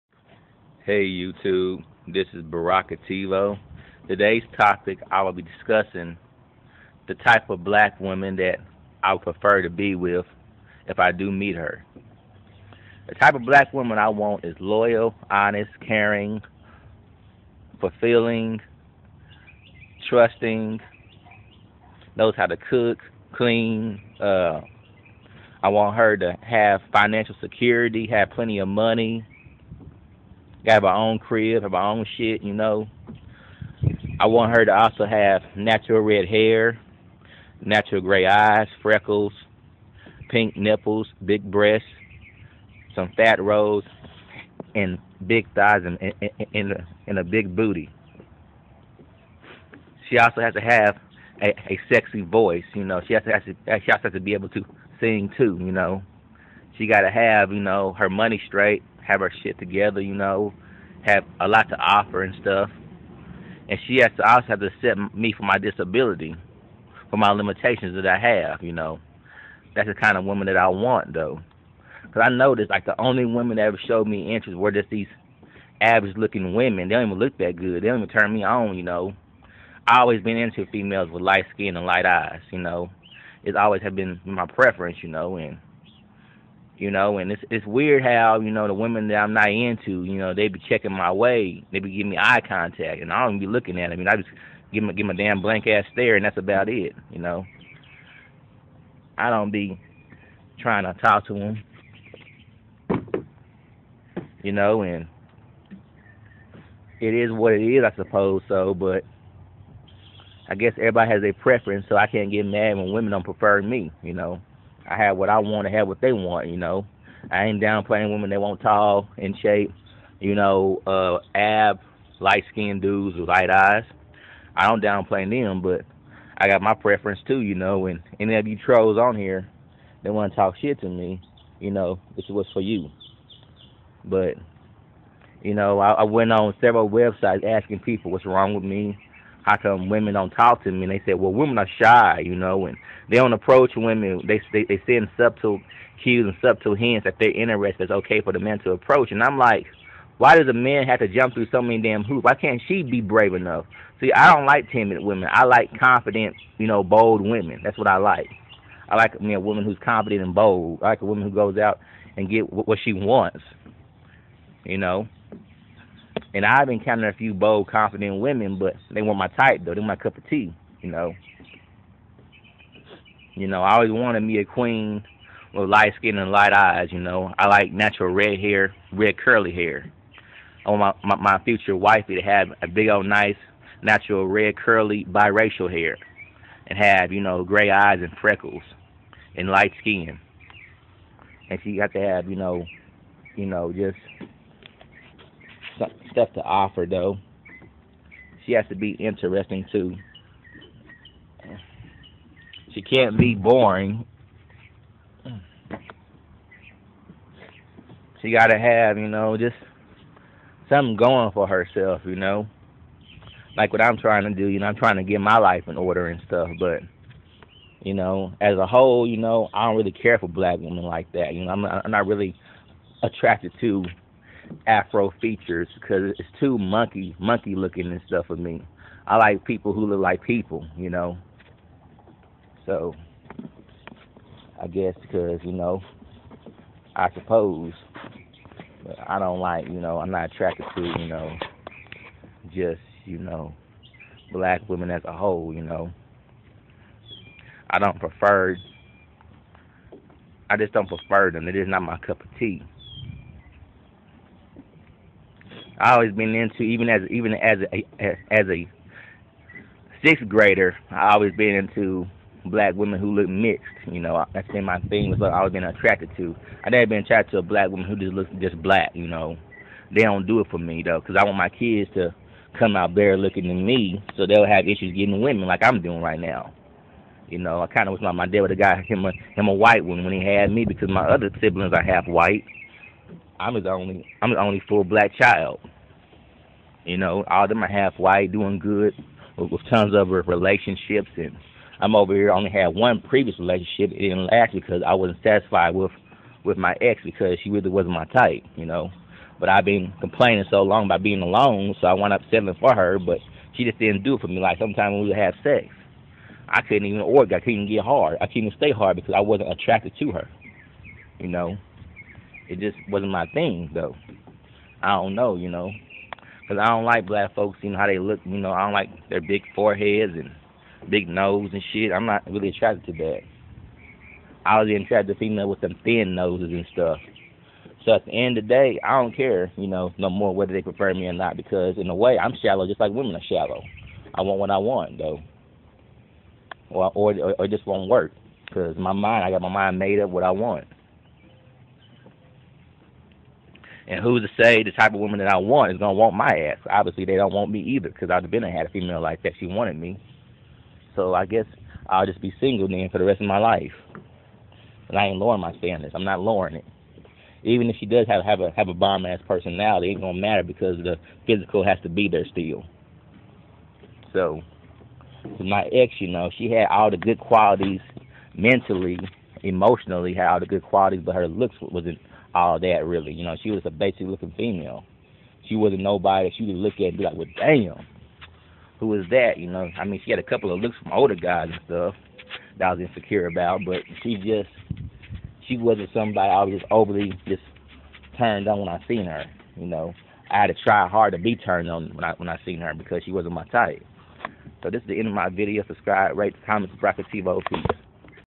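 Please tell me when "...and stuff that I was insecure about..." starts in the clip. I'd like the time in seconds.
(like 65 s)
381 s.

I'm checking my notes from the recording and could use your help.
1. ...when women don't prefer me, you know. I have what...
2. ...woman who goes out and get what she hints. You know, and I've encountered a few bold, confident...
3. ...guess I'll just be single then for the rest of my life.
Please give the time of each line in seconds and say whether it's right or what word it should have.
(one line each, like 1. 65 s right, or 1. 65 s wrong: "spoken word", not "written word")
1. 112 s right
2. 161 s wrong: "wants", not "hints"
3. 351 s right.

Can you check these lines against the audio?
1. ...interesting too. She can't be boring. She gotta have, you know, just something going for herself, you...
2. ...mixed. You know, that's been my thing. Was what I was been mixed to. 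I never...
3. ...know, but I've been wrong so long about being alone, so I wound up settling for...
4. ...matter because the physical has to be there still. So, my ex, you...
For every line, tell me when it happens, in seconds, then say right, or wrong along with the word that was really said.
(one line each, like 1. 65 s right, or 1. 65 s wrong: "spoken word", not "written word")
1. 198 s right
2. 263 s wrong: "attracted", not "mixed"
3. 298 s wrong: "complaining", not "wrong"
4. 360 s right.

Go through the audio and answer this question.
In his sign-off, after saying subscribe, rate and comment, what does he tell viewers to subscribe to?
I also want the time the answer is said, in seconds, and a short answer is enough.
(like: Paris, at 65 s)
TiVo, at 397 s.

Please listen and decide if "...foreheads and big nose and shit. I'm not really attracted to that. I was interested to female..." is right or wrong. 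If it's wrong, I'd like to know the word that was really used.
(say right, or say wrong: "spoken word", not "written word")
wrong: "attracted", not "interested".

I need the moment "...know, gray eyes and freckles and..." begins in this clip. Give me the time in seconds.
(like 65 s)
187 s.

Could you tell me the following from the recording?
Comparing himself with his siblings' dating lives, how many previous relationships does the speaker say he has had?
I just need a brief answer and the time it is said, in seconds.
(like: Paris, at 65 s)
1, at 292 s.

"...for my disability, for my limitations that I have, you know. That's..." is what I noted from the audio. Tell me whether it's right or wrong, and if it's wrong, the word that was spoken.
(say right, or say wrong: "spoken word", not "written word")
right.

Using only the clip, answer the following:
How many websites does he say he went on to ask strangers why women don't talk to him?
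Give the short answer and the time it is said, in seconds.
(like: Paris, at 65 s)
several, at 136 s.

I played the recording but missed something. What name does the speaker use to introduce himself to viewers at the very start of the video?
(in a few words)
Barakativo.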